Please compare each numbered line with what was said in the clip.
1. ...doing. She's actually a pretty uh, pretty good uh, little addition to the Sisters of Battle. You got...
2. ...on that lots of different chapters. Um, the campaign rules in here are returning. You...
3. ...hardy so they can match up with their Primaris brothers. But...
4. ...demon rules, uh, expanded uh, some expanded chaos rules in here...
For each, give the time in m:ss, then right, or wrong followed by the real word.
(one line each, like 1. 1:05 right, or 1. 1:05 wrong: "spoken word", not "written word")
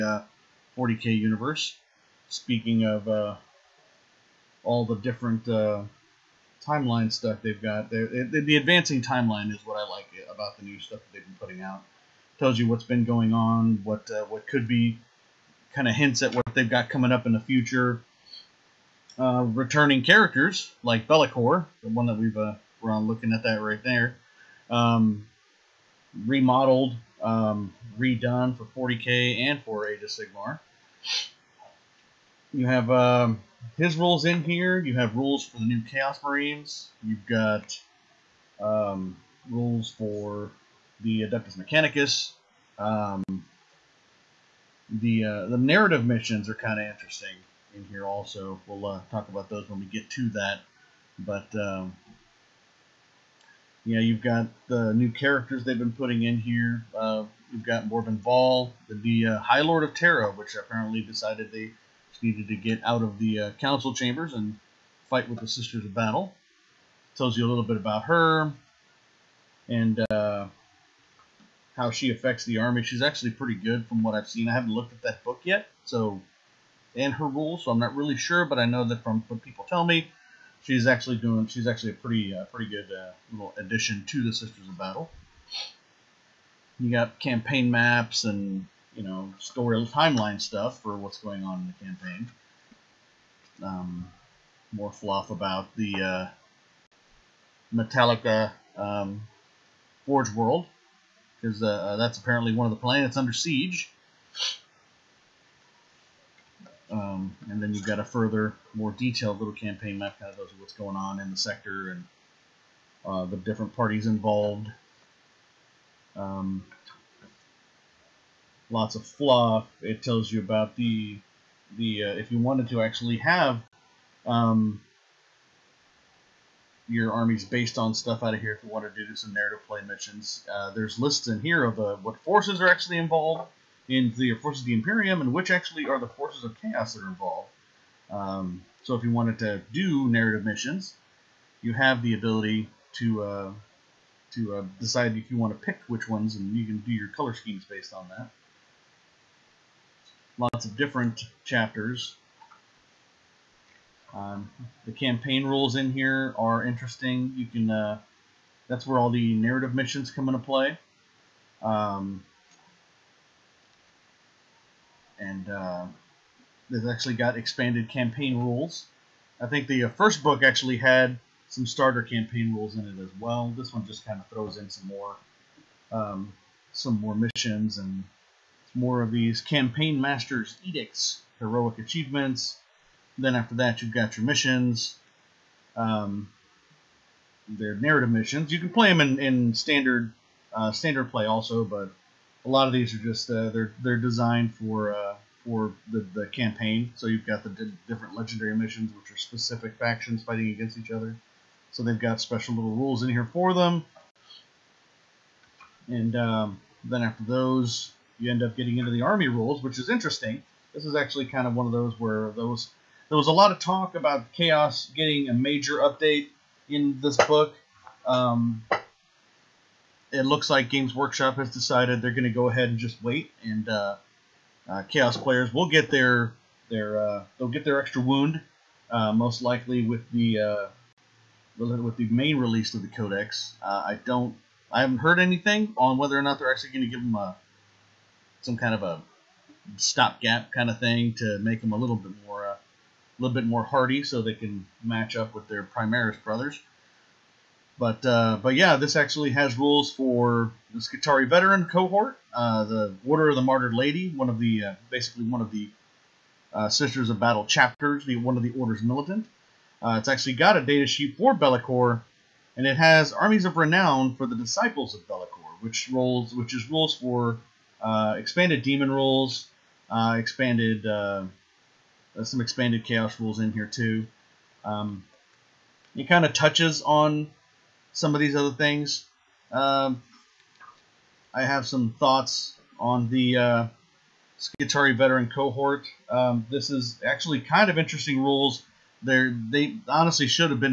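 1. 1:21 right
2. 2:27 wrong: "interesting", not "returning"
3. 4:03 right
4. 4:28 right.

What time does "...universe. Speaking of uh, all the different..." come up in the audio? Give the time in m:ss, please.
0:01.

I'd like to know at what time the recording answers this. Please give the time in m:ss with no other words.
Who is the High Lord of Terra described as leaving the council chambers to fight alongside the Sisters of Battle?
0:57.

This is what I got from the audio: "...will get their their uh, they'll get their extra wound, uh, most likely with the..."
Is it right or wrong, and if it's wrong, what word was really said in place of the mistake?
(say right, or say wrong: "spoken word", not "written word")
right.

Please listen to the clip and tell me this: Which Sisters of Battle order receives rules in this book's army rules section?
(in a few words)
Order of the Martyred Lady.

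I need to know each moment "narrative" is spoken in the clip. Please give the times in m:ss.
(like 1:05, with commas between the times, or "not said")
0:45, 2:09, 2:20, 2:39, 3:07.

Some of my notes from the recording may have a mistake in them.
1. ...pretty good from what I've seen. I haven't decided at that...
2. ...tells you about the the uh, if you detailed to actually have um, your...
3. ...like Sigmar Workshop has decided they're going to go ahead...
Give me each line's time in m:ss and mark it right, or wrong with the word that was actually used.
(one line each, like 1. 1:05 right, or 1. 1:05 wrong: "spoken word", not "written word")
1. 1:13 wrong: "looked", not "decided"
2. 2:00 wrong: "wanted", not "detailed"
3. 3:40 wrong: "Games", not "Sigmar".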